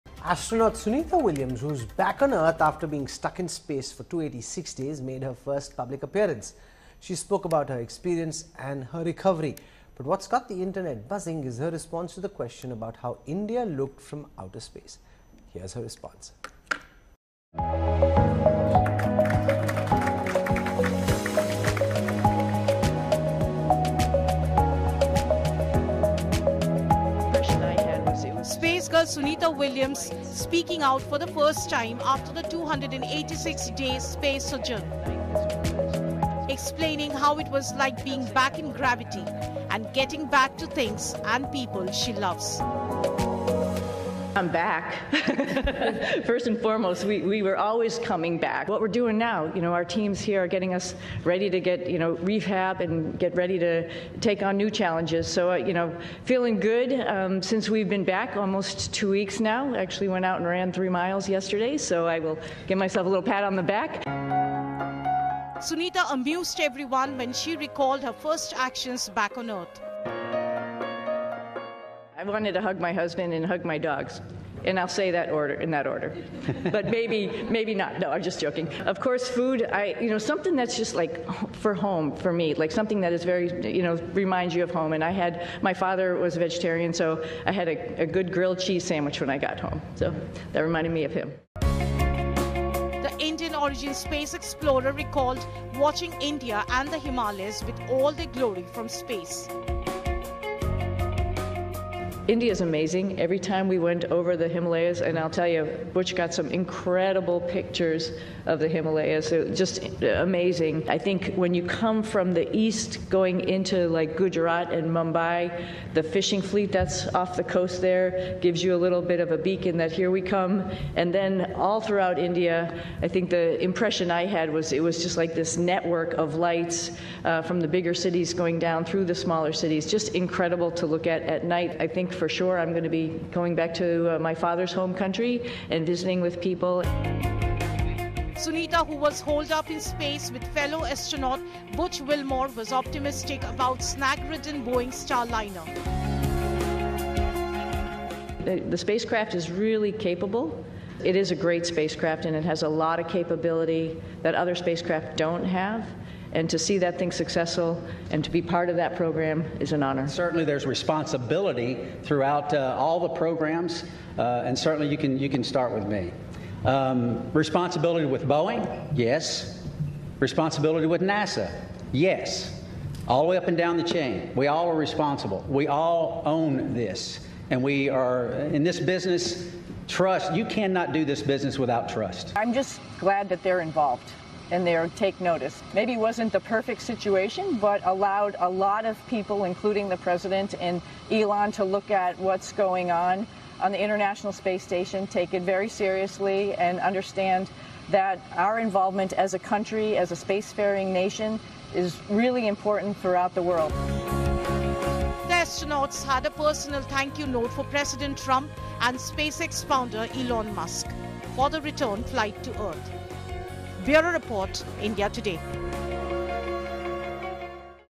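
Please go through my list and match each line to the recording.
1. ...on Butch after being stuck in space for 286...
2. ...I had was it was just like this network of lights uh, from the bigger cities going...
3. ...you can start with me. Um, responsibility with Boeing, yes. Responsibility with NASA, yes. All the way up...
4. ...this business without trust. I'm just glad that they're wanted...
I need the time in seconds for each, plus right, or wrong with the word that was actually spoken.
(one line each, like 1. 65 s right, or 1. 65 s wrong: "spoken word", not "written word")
1. 2 s wrong: "Earth", not "Butch"
2. 124 s right
3. 165 s right
4. 181 s wrong: "involved", not "wanted".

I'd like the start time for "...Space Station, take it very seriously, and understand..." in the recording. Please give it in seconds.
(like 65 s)
194 s.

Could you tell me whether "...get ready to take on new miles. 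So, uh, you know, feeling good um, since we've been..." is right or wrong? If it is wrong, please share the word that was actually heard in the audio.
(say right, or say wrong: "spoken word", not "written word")
wrong: "challenges", not "miles".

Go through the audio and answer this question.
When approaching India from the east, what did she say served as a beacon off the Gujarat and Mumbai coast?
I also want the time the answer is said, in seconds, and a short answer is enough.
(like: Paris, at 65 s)
Fishing fleet, at 116 s.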